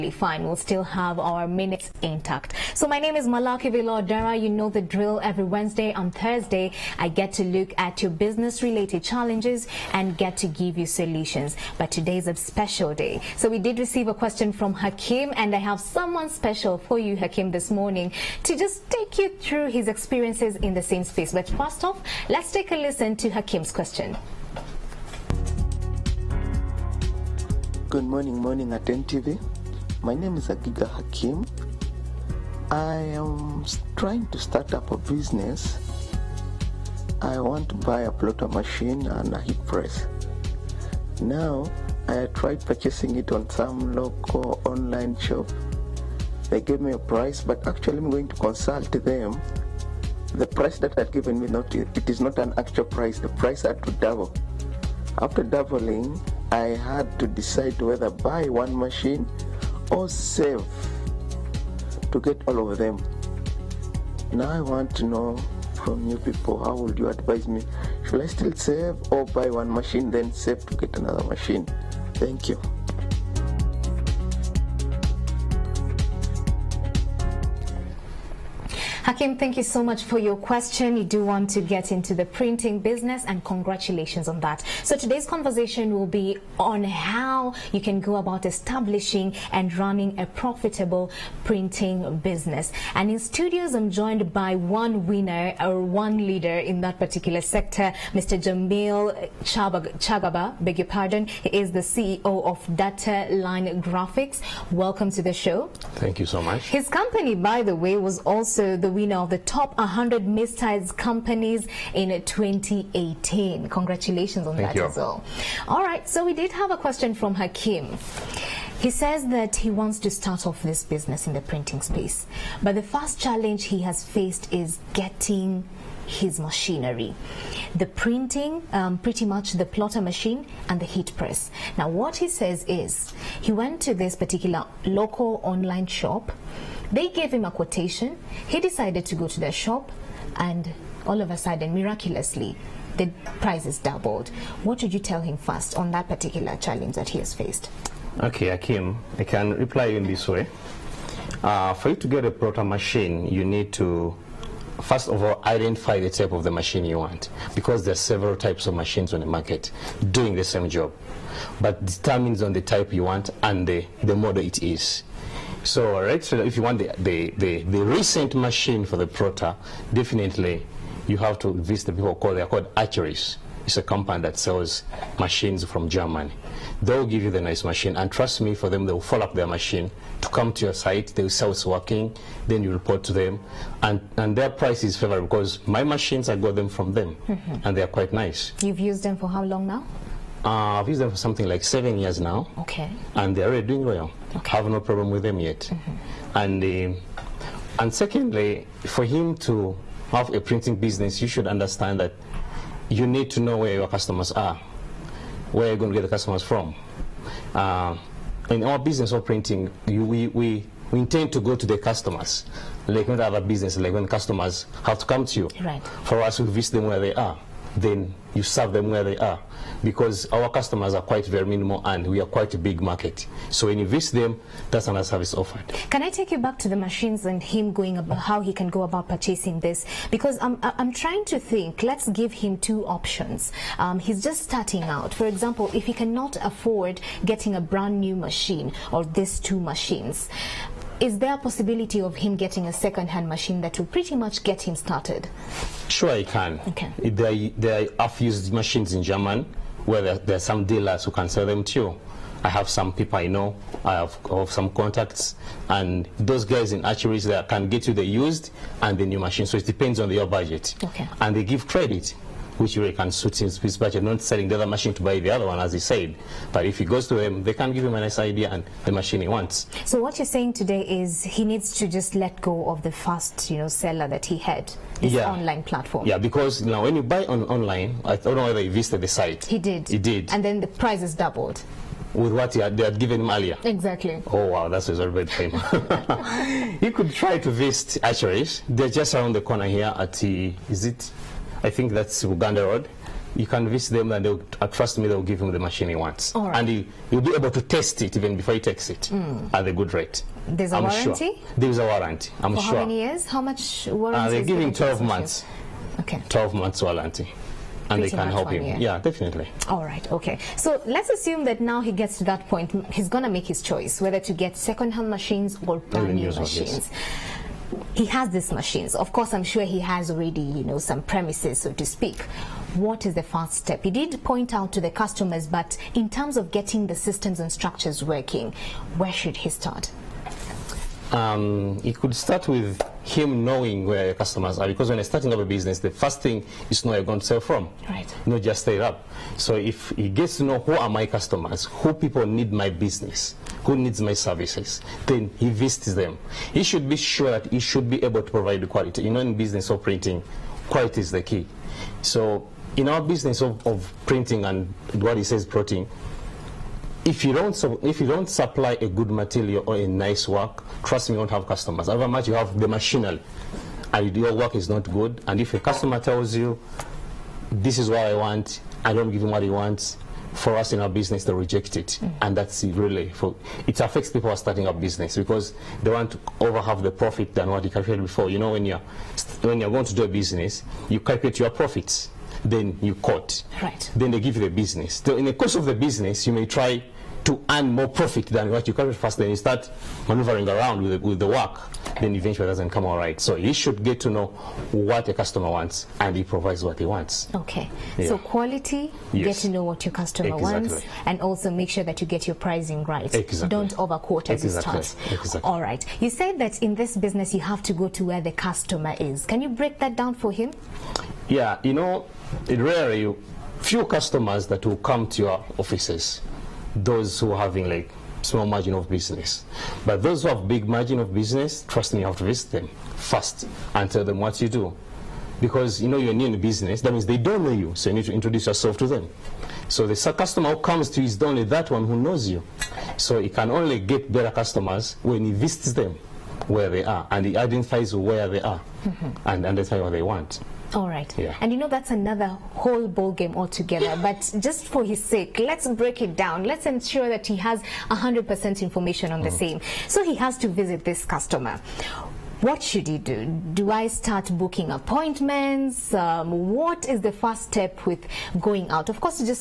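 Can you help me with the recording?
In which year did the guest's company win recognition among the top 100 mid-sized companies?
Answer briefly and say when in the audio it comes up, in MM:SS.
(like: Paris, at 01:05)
2018, at 01:52.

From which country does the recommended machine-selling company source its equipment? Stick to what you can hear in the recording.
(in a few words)
Germany.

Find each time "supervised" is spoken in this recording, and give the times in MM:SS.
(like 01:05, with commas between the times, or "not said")
not said.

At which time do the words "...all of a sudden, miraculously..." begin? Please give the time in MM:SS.
02:21.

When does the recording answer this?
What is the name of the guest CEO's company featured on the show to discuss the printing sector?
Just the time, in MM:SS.
01:42.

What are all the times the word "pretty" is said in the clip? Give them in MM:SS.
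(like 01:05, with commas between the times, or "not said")
02:08, 04:03.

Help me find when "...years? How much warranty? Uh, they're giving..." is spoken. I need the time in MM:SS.
05:03.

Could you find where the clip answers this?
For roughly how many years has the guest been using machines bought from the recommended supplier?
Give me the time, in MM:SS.
03:11.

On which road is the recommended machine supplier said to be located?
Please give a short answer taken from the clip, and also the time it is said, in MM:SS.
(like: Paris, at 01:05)
Uganda Road, at 04:52.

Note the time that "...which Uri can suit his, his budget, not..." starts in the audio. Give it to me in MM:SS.
04:22.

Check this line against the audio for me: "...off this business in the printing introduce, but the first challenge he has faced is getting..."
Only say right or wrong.
wrong.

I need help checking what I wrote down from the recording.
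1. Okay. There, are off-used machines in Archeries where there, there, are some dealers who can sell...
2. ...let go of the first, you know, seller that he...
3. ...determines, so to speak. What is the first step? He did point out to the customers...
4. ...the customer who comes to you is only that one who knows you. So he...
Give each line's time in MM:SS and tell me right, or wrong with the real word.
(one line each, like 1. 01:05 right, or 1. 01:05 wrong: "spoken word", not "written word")
1. 04:06 wrong: "German", not "Archeries"
2. 04:32 right
3. 05:21 wrong: "premises", not "determines"
4. 07:09 right.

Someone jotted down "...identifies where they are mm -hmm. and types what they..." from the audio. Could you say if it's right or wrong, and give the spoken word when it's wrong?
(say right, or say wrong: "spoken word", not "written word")
wrong: "identifies", not "types".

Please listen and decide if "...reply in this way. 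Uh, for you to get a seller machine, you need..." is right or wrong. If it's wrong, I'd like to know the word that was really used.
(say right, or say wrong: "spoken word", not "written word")
wrong: "proper", not "seller".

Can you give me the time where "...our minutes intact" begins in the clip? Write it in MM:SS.
00:01.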